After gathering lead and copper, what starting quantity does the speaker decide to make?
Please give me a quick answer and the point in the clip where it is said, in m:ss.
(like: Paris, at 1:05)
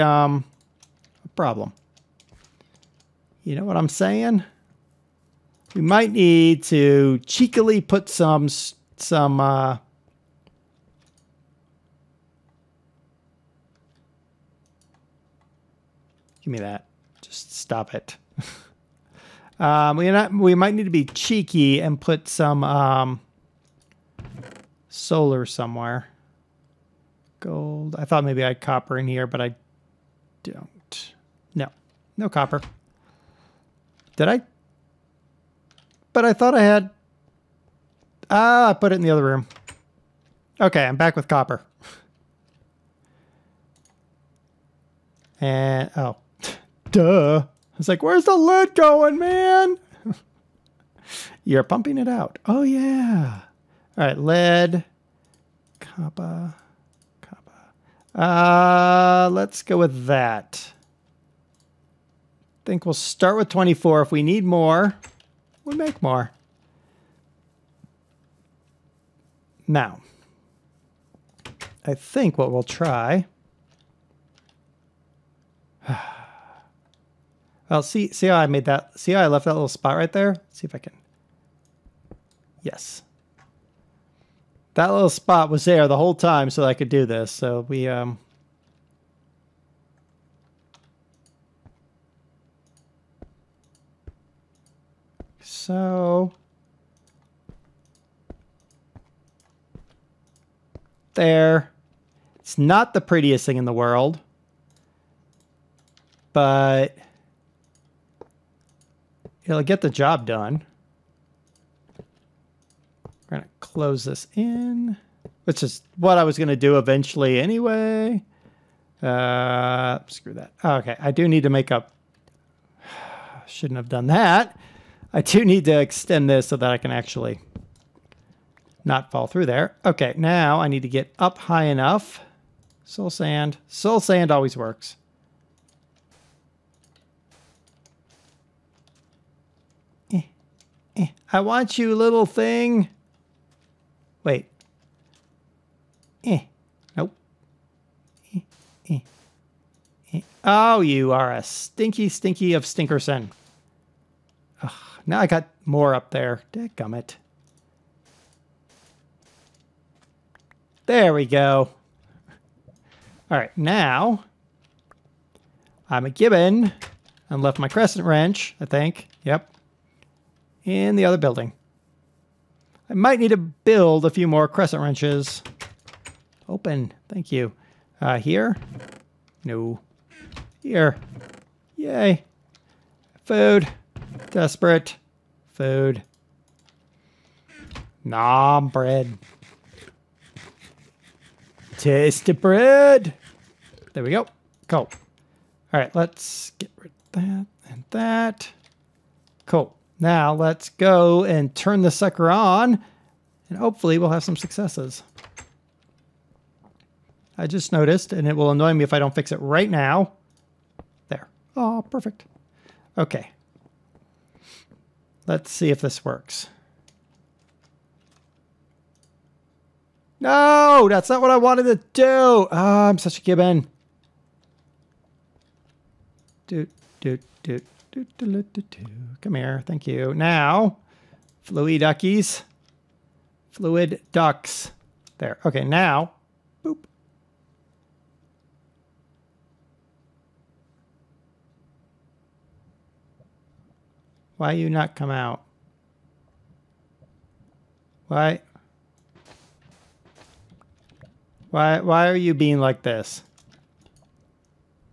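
24, at 1:03.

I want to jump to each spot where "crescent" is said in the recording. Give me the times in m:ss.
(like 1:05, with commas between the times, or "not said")
2:47, 2:54.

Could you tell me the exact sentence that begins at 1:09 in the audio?
Now, I think what we'll try...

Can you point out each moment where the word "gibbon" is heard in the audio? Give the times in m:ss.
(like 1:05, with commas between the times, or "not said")
2:46, 3:43.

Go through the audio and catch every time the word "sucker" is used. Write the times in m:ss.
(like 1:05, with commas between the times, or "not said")
3:21.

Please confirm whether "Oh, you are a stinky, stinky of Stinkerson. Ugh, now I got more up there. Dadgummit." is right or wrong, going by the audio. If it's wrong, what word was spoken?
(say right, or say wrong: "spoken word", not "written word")
right.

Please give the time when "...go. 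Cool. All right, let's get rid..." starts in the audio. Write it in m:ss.
3:14.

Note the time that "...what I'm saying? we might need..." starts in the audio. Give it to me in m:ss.
0:03.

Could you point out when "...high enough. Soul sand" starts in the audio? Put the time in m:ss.
2:11.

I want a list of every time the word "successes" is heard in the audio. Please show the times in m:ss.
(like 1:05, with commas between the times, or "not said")
3:24.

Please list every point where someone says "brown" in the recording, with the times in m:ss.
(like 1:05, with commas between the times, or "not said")
not said.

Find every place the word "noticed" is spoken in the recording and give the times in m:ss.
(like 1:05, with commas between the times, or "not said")
3:27.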